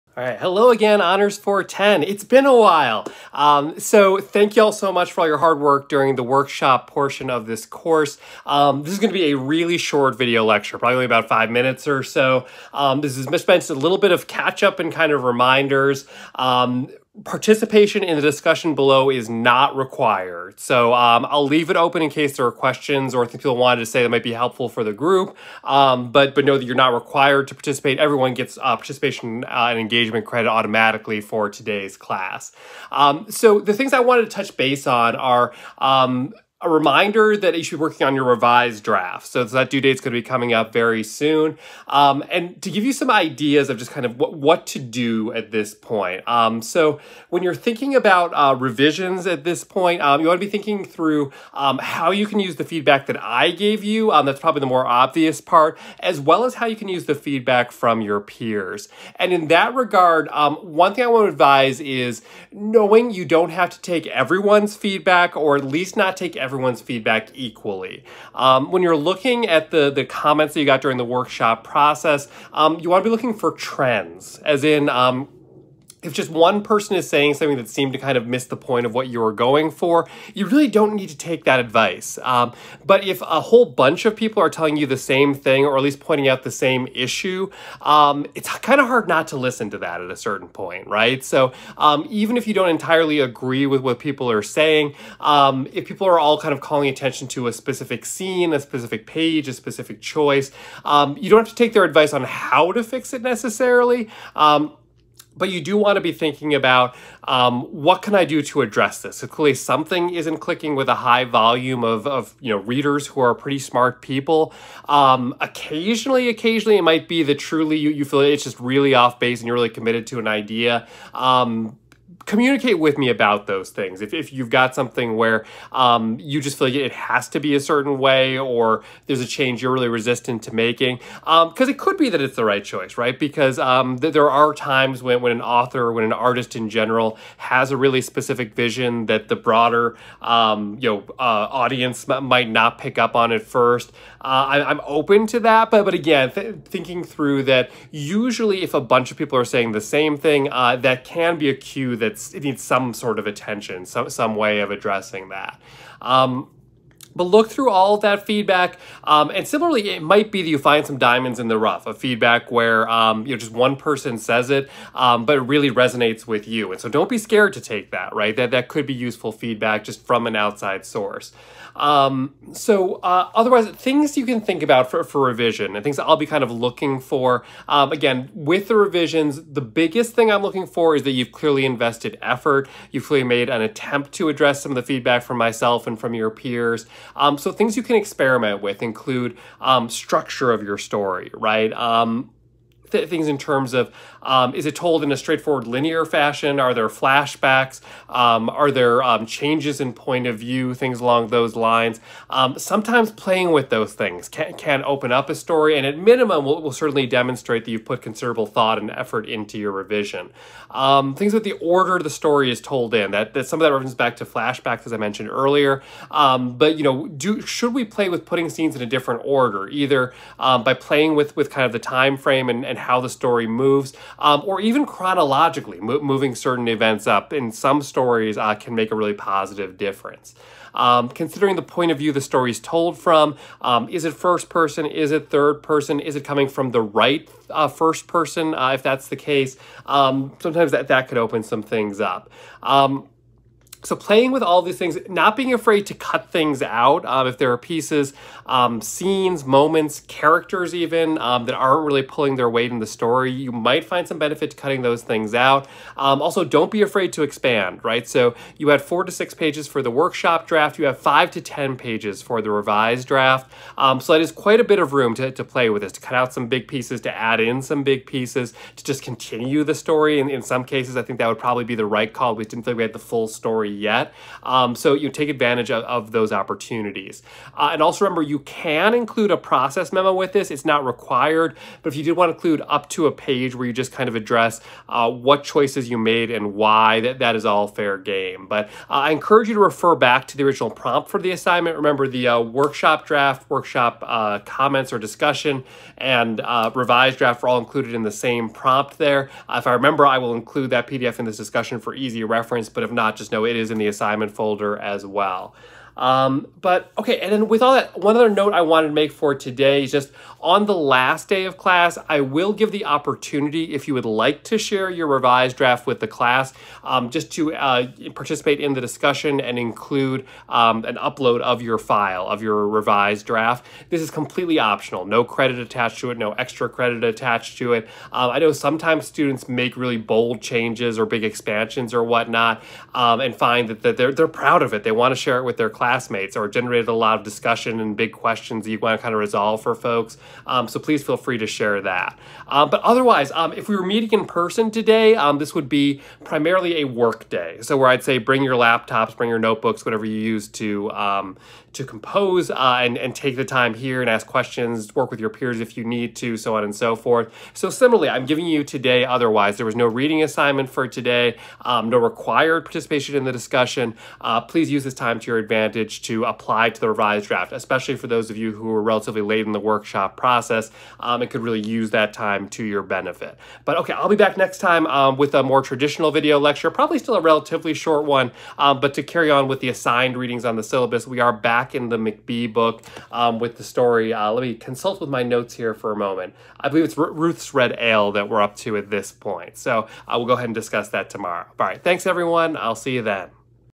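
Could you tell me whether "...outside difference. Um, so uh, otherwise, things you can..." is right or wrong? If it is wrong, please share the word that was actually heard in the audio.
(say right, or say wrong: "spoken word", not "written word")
wrong: "source", not "difference".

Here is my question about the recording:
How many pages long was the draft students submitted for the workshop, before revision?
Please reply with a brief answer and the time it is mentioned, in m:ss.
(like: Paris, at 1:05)
4 to 6, at 4:18.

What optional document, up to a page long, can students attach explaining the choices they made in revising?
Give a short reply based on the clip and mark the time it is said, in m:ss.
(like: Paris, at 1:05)
process memo, at 4:39.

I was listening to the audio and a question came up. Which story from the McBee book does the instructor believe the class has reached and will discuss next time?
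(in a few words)
Ruth's Red Ale.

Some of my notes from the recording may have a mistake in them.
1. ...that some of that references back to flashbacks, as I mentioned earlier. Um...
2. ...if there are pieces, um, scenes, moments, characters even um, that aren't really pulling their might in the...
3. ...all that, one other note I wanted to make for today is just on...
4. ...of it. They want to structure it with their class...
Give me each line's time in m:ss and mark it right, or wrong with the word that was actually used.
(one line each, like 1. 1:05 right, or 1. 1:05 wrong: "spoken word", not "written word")
1. 3:33 right
2. 4:07 wrong: "weight", not "might"
3. 5:07 right
4. 5:34 wrong: "share", not "structure".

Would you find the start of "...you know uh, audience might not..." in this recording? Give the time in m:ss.
2:20.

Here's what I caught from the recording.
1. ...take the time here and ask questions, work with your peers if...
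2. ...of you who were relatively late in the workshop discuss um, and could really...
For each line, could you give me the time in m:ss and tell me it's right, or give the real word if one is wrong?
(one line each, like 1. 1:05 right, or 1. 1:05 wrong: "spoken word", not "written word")
1. 5:53 right
2. 6:08 wrong: "process", not "discuss".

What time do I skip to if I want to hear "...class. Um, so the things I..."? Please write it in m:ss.
0:31.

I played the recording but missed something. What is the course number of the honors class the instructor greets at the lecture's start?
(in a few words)
410.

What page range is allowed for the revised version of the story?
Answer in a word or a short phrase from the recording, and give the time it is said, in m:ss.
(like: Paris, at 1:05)
5 to 10, at 4:20.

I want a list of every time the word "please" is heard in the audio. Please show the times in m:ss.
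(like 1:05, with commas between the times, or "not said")
5:40, 6:04.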